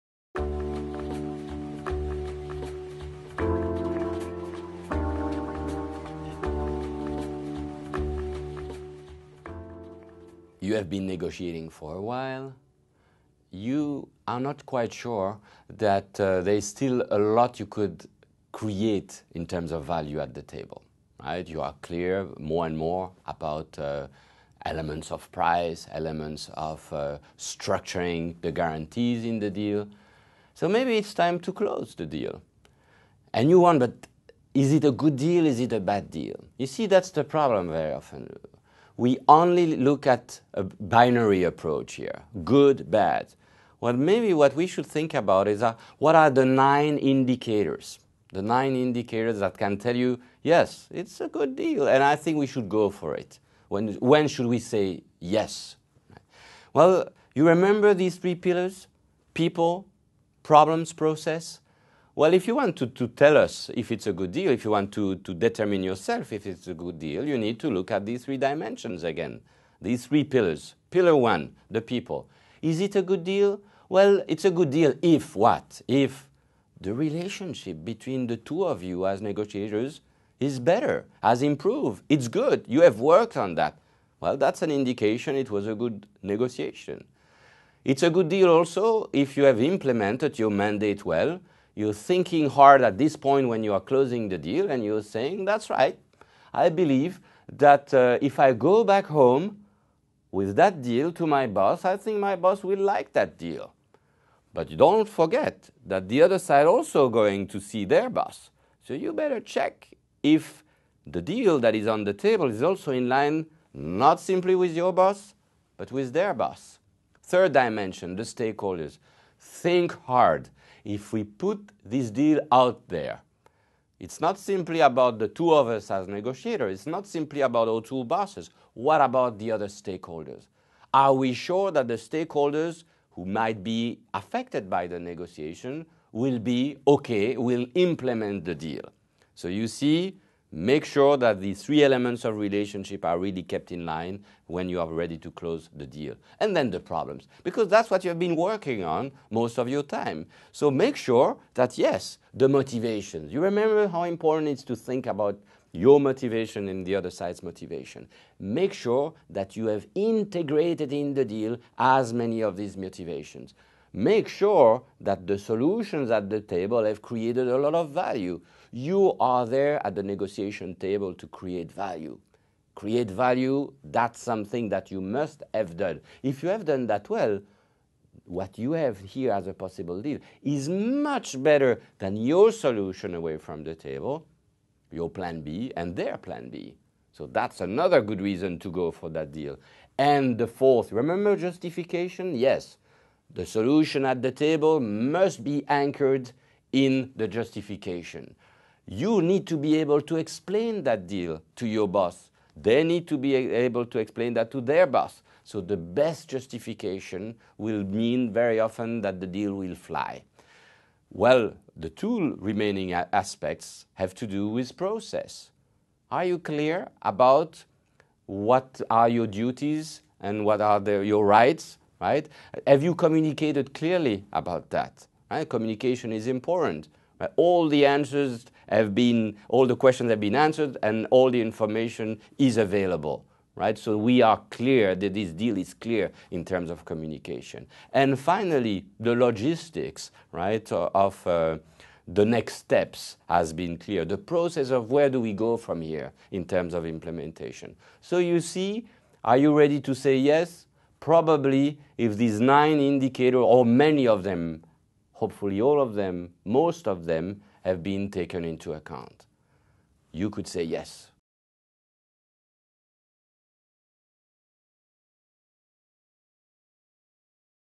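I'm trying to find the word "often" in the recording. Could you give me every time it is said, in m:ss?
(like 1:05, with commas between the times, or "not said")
0:37, 3:28.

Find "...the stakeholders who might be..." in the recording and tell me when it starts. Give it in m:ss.
2:11.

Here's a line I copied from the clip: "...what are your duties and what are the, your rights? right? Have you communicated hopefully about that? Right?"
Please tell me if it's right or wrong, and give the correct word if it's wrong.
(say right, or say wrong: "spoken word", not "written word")
wrong: "clearly", not "hopefully".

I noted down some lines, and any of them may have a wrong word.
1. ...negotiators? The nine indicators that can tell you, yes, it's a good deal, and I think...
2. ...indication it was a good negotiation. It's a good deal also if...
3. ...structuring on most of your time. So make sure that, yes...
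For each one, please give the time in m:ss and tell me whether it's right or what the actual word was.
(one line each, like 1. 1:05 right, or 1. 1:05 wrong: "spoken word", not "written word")
1. 0:46 wrong: "indicators", not "negotiators"
2. 1:24 right
3. 2:28 wrong: "working", not "structuring".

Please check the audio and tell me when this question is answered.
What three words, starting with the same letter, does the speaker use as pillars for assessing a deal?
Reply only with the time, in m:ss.
0:59.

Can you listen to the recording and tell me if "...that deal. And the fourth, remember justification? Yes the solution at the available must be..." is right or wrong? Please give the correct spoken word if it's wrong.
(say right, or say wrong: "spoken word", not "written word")
wrong: "table", not "available".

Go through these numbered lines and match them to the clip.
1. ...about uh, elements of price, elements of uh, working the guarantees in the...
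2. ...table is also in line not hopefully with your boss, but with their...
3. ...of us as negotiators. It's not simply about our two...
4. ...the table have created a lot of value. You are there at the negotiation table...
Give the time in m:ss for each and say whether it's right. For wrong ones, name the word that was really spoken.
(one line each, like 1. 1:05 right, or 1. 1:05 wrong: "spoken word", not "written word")
1. 0:23 wrong: "structuring", not "working"
2. 1:52 wrong: "simply", not "hopefully"
3. 2:05 right
4. 2:46 right.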